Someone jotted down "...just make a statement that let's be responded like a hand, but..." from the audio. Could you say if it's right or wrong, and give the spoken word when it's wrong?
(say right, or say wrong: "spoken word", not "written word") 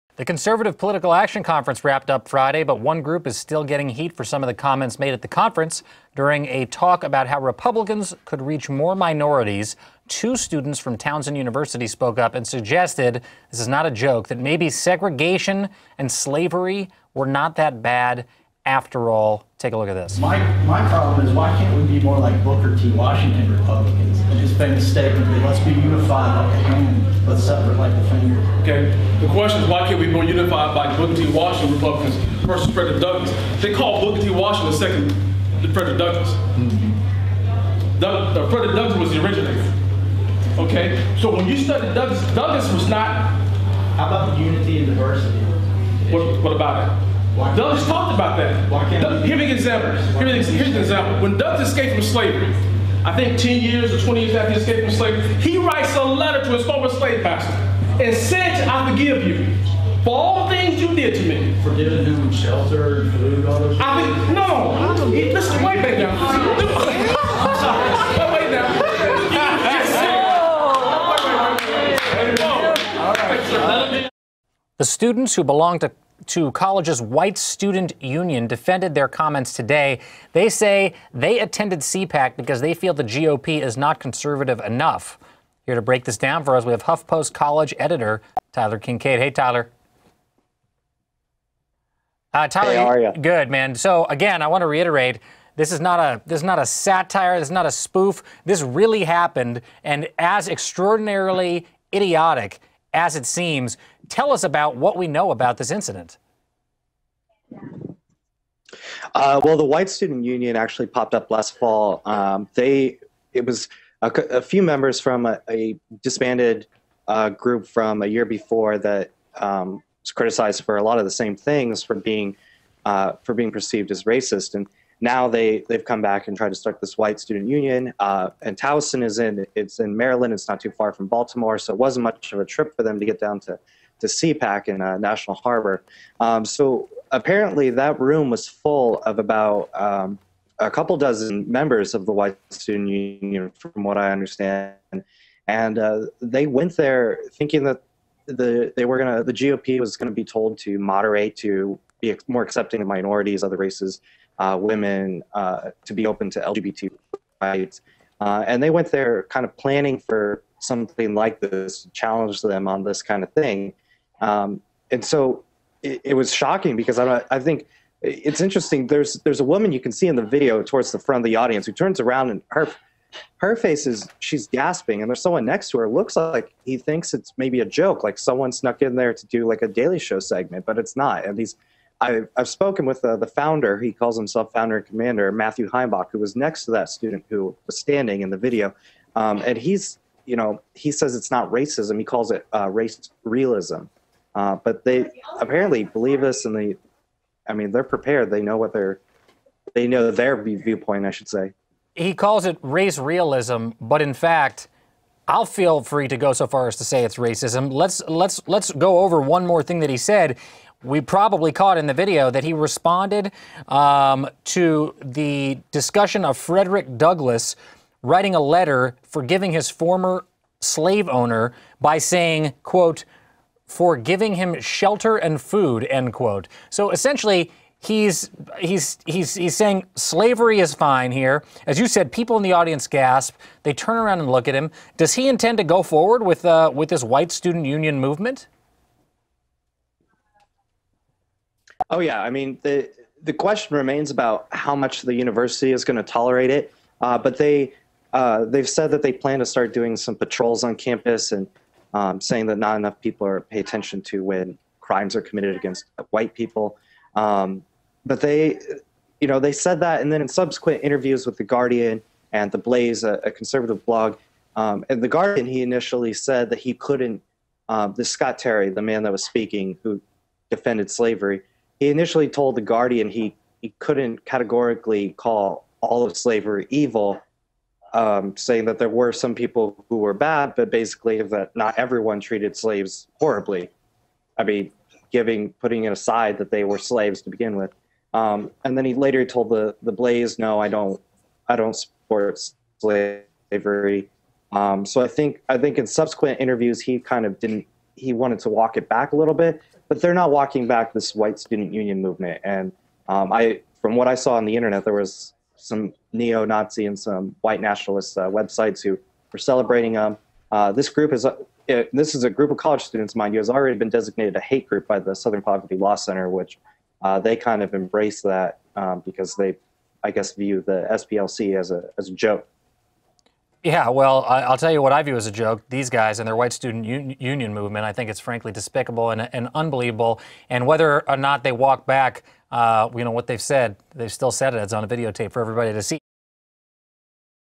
wrong: "unified", not "responded".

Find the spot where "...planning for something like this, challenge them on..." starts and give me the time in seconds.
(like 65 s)
159 s.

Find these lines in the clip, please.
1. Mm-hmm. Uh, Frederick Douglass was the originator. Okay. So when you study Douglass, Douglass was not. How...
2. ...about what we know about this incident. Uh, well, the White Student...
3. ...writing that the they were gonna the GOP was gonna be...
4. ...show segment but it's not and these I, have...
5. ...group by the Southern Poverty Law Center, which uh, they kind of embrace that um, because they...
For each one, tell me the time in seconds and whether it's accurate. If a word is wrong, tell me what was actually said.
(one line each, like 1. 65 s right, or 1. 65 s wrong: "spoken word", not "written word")
1. 36 s right
2. 104 s right
3. 147 s wrong: "thinking", not "writing"
4. 179 s right
5. 314 s right.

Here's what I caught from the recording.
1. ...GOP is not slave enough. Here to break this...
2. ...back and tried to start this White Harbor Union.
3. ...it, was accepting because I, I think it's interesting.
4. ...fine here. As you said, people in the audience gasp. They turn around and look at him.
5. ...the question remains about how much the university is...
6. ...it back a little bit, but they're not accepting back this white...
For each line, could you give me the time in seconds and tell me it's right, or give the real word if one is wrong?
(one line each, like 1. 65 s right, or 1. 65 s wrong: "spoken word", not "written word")
1. 83 s wrong: "conservative", not "slave"
2. 126 s wrong: "Student", not "Harbor"
3. 166 s wrong: "shocking", not "accepting"
4. 230 s right
5. 243 s right
6. 298 s wrong: "walking", not "accepting".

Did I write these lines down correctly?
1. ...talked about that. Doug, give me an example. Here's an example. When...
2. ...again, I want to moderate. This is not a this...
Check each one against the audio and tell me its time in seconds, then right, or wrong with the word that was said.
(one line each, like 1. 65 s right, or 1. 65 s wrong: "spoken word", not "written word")
1. 47 s right
2. 94 s wrong: "reiterate", not "moderate".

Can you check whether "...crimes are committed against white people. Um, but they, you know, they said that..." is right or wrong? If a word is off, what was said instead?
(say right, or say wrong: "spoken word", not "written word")
right.